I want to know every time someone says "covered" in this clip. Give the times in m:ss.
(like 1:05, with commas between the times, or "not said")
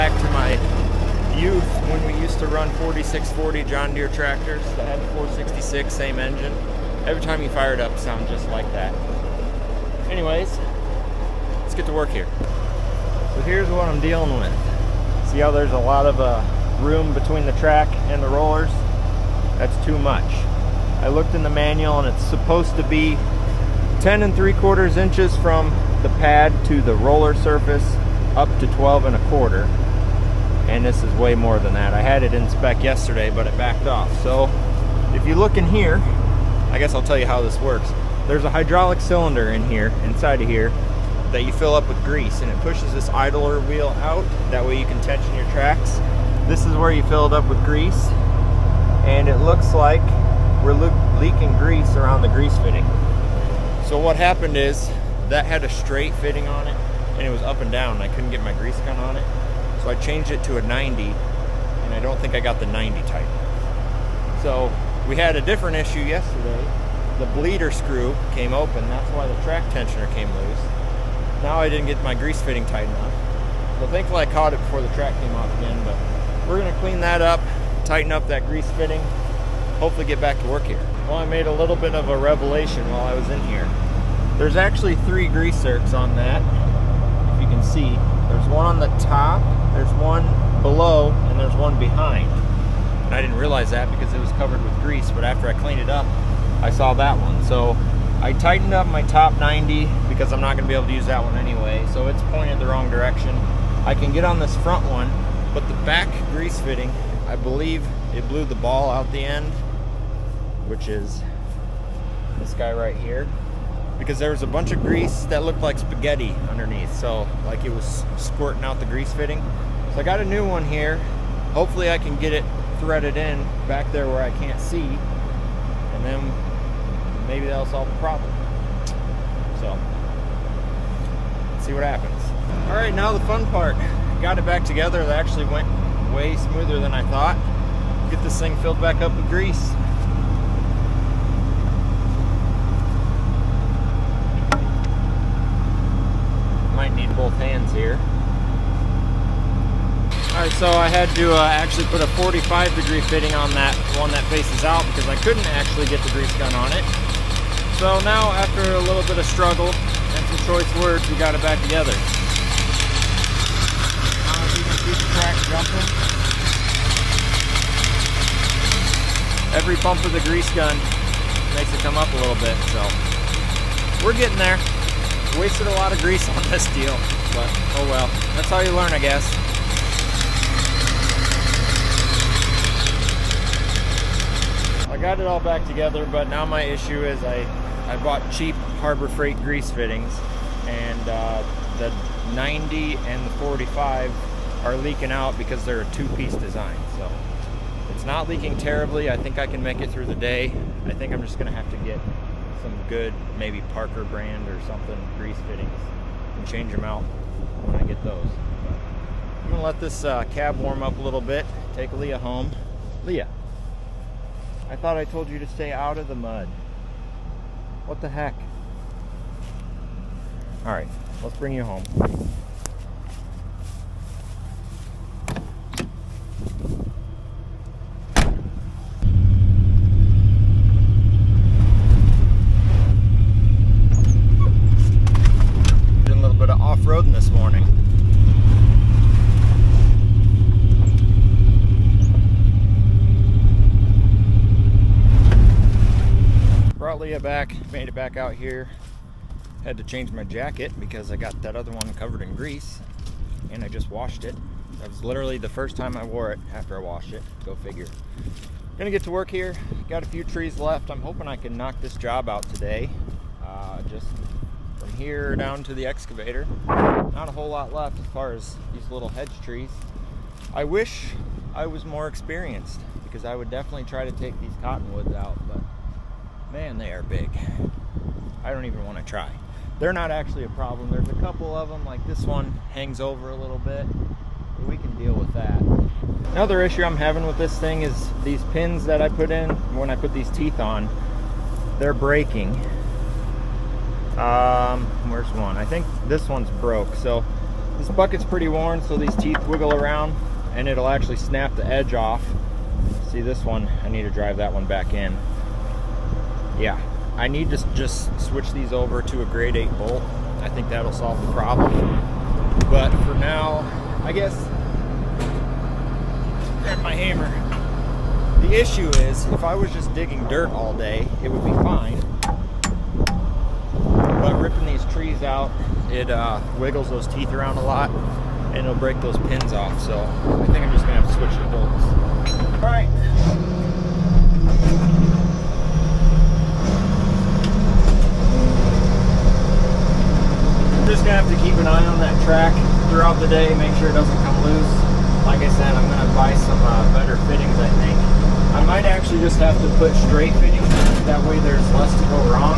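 1:34, 4:11.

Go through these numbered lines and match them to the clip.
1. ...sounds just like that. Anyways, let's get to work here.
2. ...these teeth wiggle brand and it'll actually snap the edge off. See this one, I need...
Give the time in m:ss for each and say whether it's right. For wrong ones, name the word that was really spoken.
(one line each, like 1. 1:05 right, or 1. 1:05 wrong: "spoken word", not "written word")
1. 0:07 right
2. 4:58 wrong: "around", not "brand".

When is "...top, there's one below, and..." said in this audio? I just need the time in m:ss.
1:28.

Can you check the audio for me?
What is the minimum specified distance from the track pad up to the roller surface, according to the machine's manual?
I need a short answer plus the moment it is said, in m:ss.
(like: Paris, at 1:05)
10 3/4 inches, at 0:24.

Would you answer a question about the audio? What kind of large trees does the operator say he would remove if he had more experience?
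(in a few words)
cottonwoods.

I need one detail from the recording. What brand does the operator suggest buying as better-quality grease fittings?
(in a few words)
Parker.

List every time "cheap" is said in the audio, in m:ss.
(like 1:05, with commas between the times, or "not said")
3:08.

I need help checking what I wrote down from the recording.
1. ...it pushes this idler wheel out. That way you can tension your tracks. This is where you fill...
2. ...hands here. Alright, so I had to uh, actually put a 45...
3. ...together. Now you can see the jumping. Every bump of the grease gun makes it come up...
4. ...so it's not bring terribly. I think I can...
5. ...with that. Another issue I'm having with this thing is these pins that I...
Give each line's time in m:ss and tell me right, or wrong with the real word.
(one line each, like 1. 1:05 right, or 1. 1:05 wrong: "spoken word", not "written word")
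1. 0:42 right
2. 2:27 right
3. 2:41 right
4. 3:16 wrong: "leaking", not "bring"
5. 4:45 right.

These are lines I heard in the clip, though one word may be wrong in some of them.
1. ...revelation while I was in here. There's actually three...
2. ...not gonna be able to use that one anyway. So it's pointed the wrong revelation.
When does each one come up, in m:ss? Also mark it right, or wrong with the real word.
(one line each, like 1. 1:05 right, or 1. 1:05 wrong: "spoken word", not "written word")
1. 1:22 right
2. 1:40 wrong: "direction", not "revelation".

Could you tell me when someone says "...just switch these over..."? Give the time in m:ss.
5:07.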